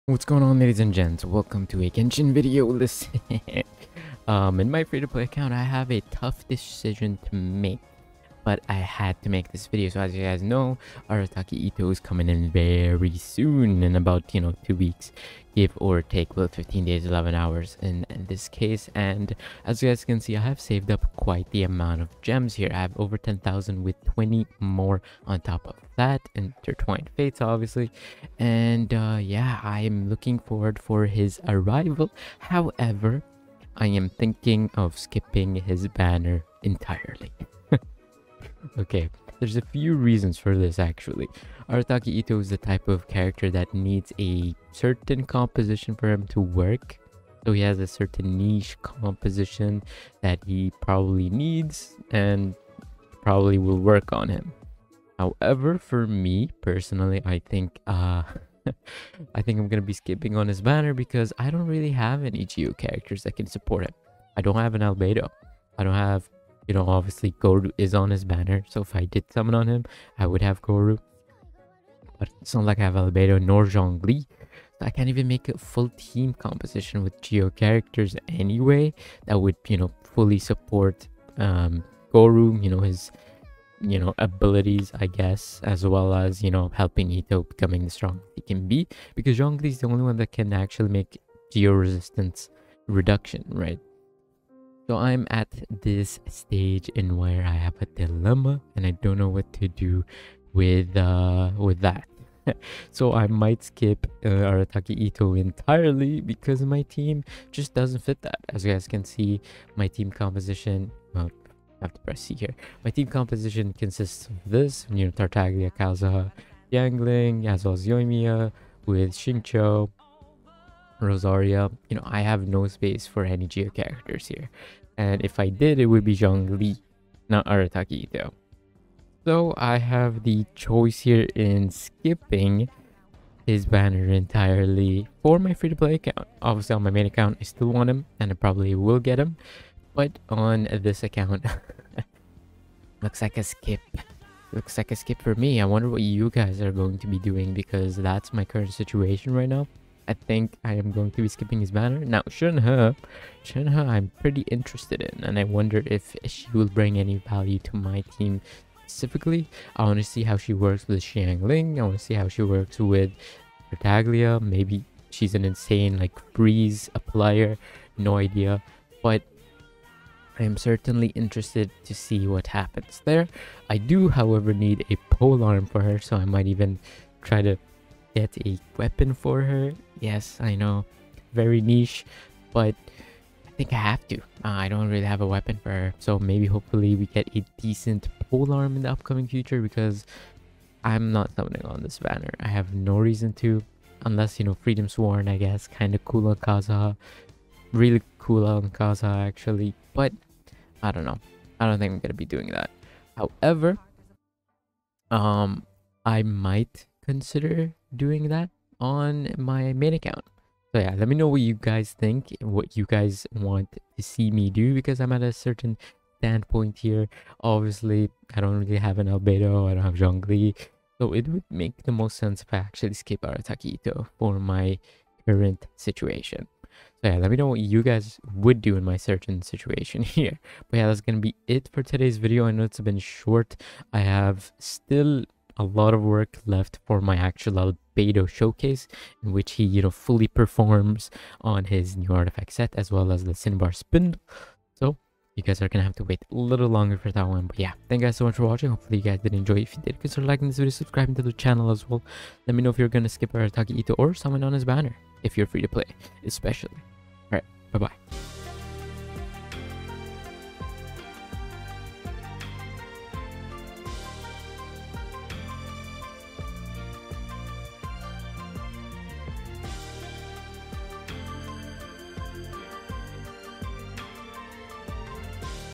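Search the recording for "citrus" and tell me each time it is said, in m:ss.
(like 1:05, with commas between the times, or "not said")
not said.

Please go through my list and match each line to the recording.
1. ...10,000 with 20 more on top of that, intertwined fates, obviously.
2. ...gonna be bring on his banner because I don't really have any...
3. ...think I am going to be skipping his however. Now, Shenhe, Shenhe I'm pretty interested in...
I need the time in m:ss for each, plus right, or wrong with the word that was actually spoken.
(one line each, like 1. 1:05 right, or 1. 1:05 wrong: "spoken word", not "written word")
1. 0:23 right
2. 0:59 wrong: "skipping", not "bring"
3. 2:30 wrong: "banner", not "however".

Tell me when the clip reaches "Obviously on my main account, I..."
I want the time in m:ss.
2:16.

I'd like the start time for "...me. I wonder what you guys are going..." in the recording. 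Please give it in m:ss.
2:25.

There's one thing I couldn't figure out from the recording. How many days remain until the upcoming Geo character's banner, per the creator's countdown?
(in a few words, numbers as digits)
15 days.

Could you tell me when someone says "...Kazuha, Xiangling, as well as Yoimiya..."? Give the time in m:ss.
1:55.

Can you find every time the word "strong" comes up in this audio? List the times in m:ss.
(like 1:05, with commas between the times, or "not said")
1:27.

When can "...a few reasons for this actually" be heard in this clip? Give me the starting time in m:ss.
0:39.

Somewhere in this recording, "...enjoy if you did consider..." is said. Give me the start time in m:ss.
4:09.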